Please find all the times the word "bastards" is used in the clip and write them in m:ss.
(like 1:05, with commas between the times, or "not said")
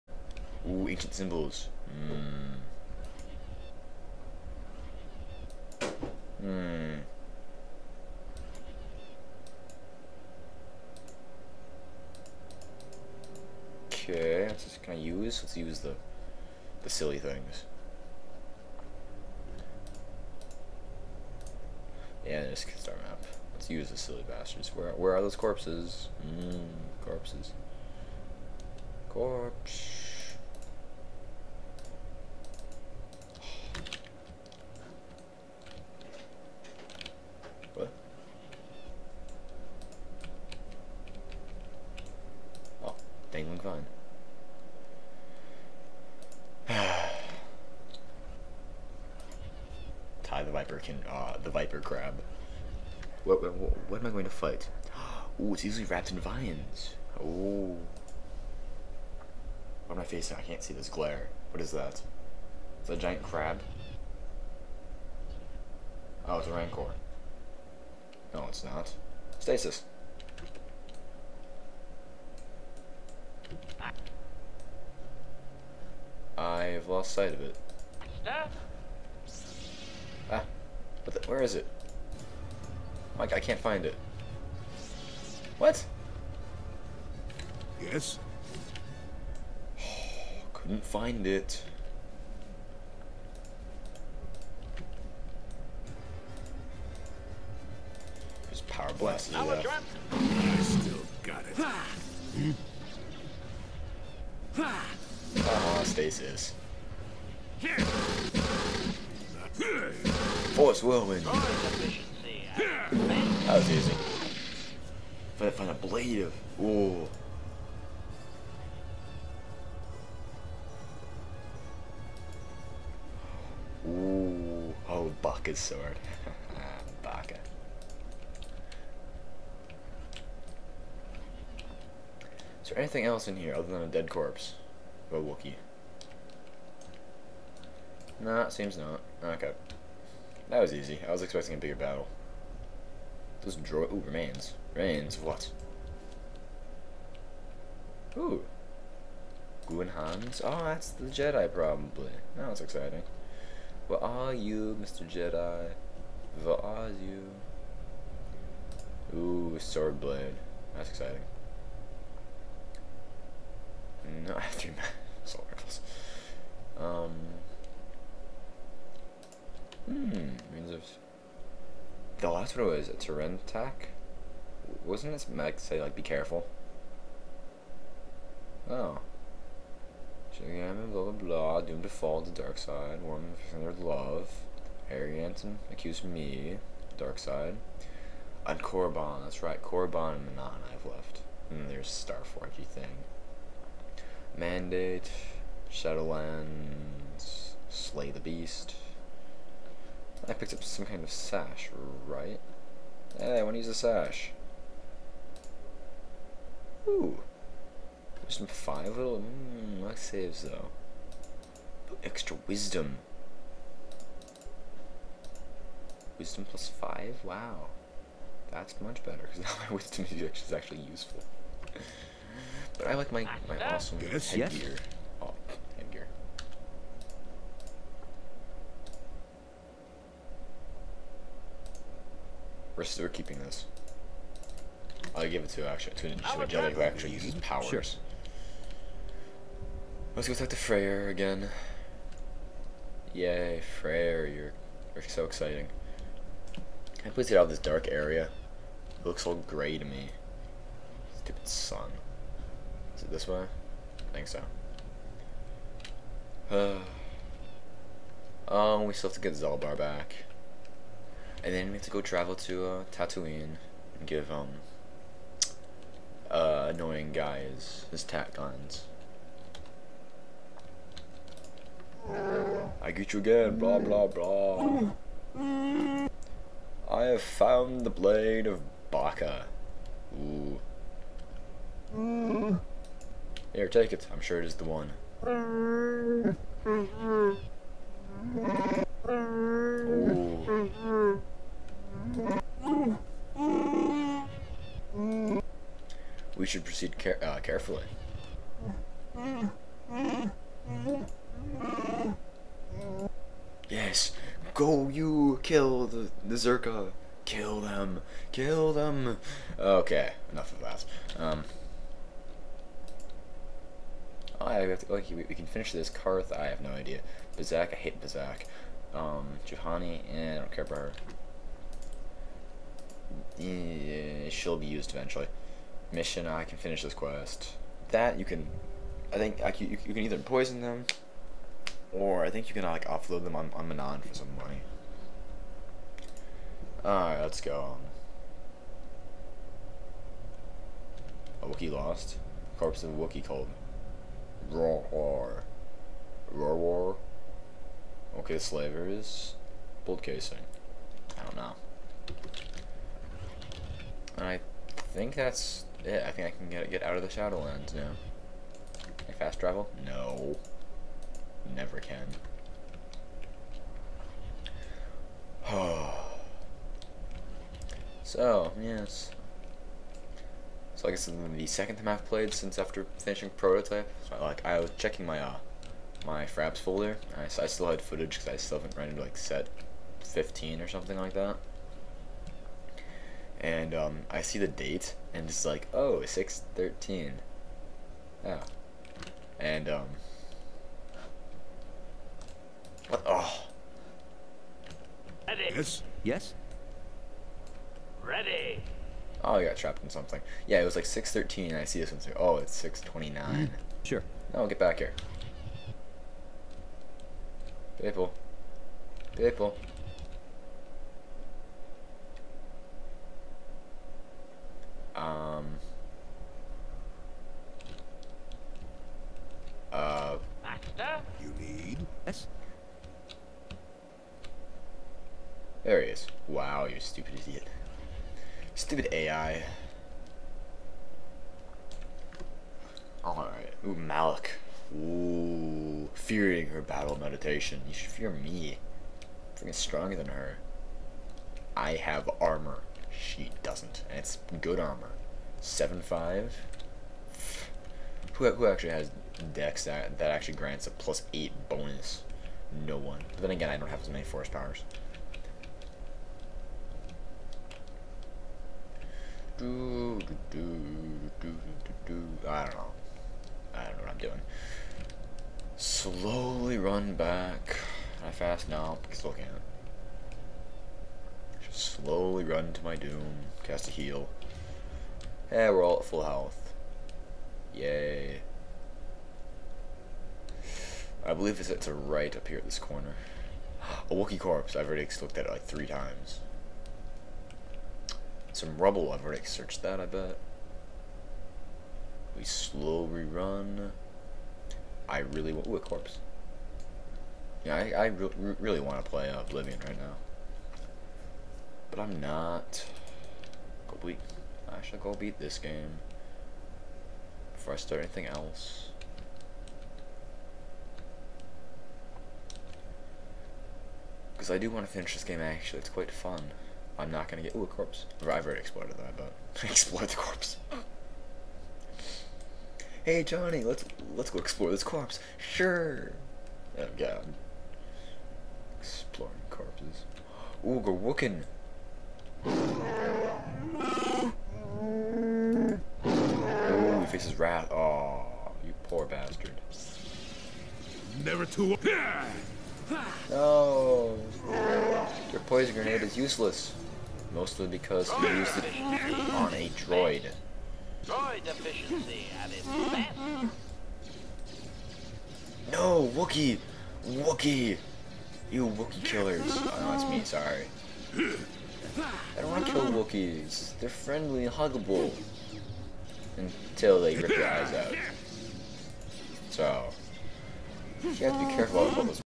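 0:24, 8:58.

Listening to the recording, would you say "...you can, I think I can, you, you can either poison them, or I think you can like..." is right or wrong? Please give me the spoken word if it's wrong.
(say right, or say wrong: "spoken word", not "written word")
right.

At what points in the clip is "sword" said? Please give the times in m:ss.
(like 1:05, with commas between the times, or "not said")
2:05, 2:39.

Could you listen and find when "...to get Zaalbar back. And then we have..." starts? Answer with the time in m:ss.
4:19.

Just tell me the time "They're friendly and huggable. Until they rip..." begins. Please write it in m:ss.
9:23.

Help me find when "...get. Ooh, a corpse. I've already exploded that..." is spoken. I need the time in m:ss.
8:37.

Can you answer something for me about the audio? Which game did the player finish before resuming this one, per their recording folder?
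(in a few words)
Prototype.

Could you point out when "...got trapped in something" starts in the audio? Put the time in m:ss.
6:39.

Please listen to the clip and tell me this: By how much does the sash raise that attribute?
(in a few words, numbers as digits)
5.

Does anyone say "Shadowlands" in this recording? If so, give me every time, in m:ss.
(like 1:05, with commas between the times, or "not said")
3:15, 5:57.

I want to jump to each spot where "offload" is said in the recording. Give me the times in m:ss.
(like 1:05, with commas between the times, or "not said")
5:32.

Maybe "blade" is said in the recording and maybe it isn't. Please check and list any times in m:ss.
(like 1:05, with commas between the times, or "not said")
1:55, 2:40, 4:37.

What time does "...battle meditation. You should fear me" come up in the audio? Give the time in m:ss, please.
7:16.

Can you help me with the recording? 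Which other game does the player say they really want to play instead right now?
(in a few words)
Oblivion.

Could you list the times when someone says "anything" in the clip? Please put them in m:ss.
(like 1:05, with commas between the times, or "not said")
2:12, 8:27.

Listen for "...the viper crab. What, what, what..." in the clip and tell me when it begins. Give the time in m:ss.
0:51.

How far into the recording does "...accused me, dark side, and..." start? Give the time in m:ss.
3:05.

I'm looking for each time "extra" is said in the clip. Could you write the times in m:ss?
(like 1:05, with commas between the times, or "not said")
3:32.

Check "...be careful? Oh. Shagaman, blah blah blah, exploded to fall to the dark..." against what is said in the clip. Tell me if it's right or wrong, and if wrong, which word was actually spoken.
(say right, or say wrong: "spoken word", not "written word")
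wrong: "doomed", not "exploded".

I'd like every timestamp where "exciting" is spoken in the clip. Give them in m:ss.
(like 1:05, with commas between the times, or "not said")
2:32, 4:05.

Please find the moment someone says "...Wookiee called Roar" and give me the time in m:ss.
5:42.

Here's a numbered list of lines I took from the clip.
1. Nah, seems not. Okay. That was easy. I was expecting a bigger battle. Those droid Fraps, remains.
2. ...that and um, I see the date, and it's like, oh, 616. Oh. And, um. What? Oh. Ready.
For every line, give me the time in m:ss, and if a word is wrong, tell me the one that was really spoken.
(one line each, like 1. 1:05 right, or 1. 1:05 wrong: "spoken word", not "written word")
1. 2:18 wrong: "Ooh", not "Fraps"
2. 6:21 wrong: "613", not "616".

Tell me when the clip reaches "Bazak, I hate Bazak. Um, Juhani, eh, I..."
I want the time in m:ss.
5:17.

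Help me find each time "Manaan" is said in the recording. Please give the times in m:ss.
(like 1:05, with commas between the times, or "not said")
3:10, 5:33.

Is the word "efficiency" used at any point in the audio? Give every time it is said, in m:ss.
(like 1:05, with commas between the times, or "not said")
9:11.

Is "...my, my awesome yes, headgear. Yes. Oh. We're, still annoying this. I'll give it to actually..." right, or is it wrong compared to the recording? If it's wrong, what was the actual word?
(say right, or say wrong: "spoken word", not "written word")
wrong: "keeping", not "annoying".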